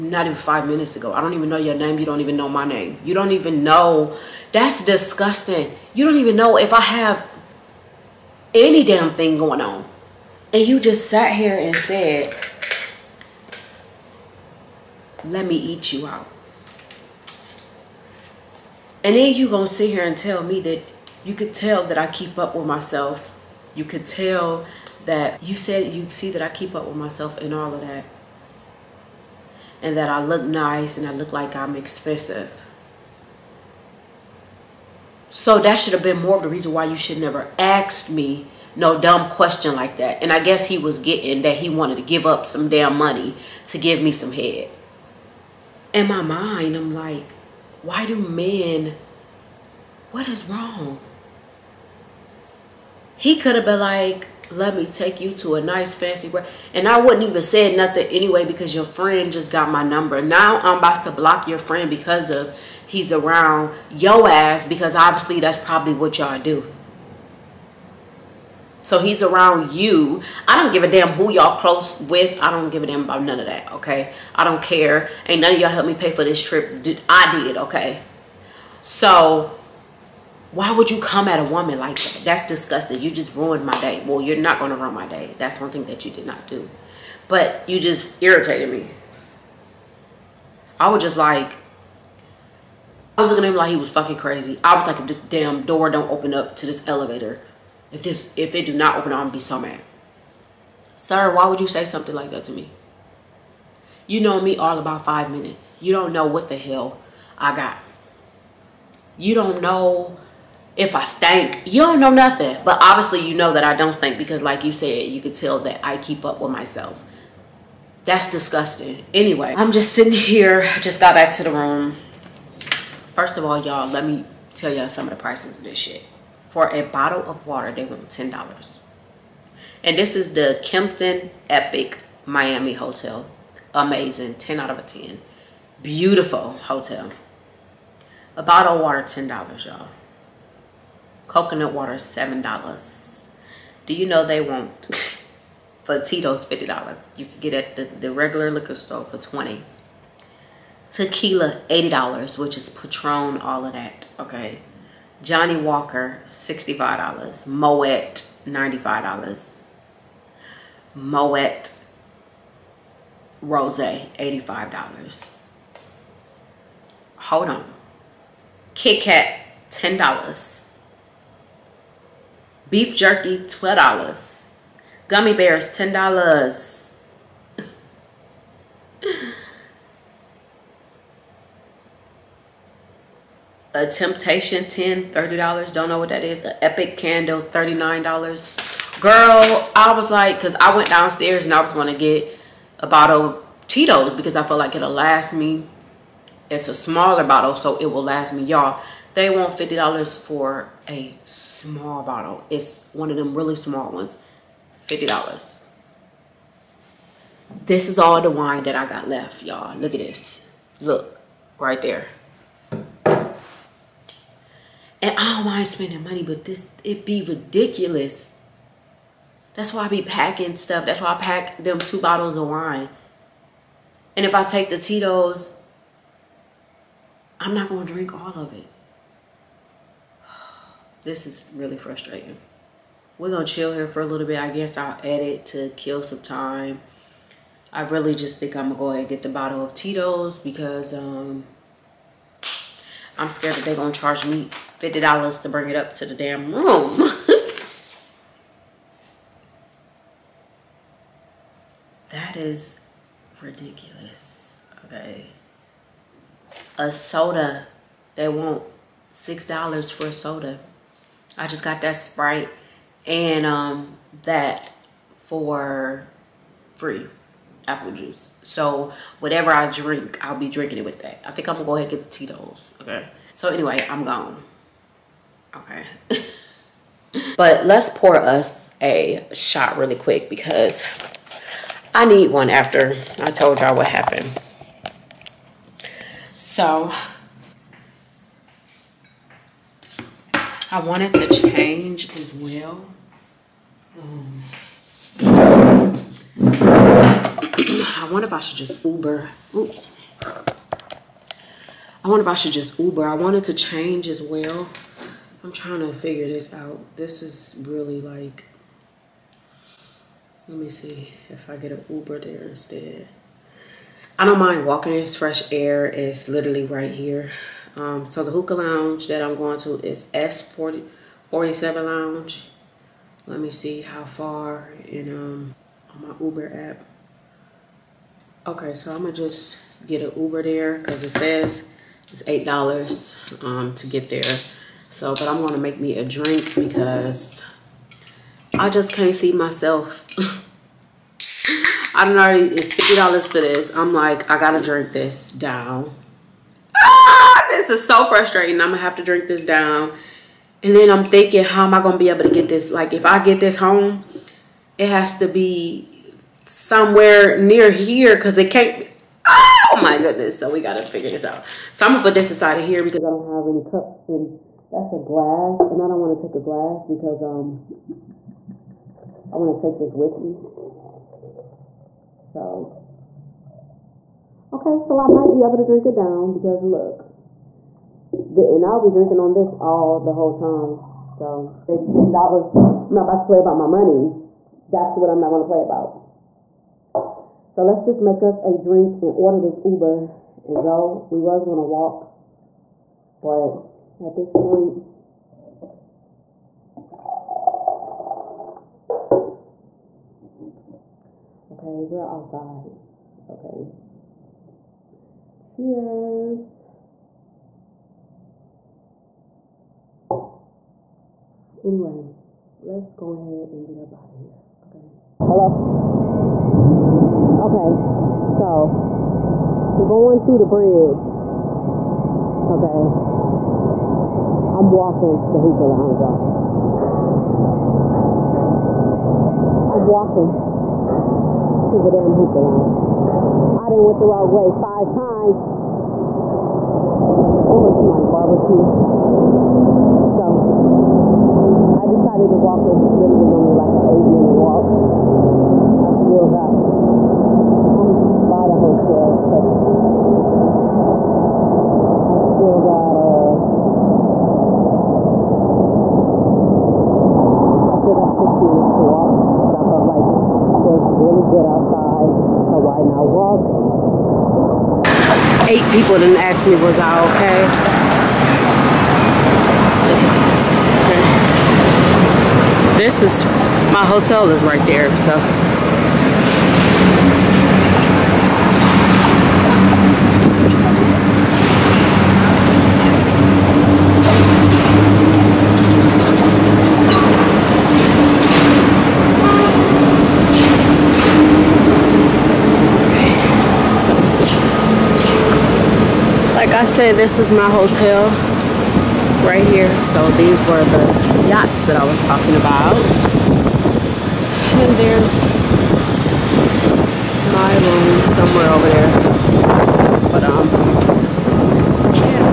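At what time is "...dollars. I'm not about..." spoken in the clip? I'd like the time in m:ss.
6:22.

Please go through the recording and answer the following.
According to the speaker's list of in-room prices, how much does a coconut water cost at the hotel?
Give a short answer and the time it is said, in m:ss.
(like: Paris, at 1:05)
$7, at 2:21.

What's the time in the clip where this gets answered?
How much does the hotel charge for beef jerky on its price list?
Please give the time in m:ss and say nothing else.
2:53.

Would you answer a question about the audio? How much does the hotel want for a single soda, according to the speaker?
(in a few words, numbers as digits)
$6.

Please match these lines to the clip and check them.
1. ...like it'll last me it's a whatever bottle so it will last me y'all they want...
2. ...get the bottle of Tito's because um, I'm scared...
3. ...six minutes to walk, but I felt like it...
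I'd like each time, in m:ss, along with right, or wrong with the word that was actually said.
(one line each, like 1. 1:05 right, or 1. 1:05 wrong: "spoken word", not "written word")
1. 3:14 wrong: "smaller", not "whatever"
2. 3:59 right
3. 7:38 right.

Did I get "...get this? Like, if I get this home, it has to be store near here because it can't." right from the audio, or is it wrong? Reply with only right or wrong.
wrong.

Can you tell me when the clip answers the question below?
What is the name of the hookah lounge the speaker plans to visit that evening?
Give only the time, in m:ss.
5:20.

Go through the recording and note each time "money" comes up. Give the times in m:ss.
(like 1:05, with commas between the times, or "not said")
0:42, 3:36, 6:23.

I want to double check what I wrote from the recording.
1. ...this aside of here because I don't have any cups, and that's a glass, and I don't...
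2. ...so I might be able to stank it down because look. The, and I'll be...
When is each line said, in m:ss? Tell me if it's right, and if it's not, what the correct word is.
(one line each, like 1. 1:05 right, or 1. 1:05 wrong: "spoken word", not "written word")
1. 6:02 right
2. 6:14 wrong: "drink", not "stank".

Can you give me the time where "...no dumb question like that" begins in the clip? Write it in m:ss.
0:38.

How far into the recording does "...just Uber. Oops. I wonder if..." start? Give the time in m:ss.
4:58.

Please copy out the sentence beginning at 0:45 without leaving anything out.
In my mind, I'm like, why do men, what is wrong?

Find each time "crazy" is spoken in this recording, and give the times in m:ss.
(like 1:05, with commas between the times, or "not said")
1:34.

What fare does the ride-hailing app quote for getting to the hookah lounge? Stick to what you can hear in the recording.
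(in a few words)
$8.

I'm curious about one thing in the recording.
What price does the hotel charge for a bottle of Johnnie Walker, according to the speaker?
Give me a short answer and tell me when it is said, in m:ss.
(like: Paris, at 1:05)
$65, at 2:36.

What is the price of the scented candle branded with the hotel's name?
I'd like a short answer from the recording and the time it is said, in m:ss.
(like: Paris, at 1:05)
$39, at 3:07.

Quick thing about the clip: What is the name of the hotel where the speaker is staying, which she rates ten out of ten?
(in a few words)
Kimpton Epic Miami Hotel.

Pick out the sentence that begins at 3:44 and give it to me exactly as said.
And if I take the Tito's, I'm not going to drink all of it.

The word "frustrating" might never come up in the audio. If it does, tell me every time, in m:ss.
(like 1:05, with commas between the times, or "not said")
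3:51, 5:48.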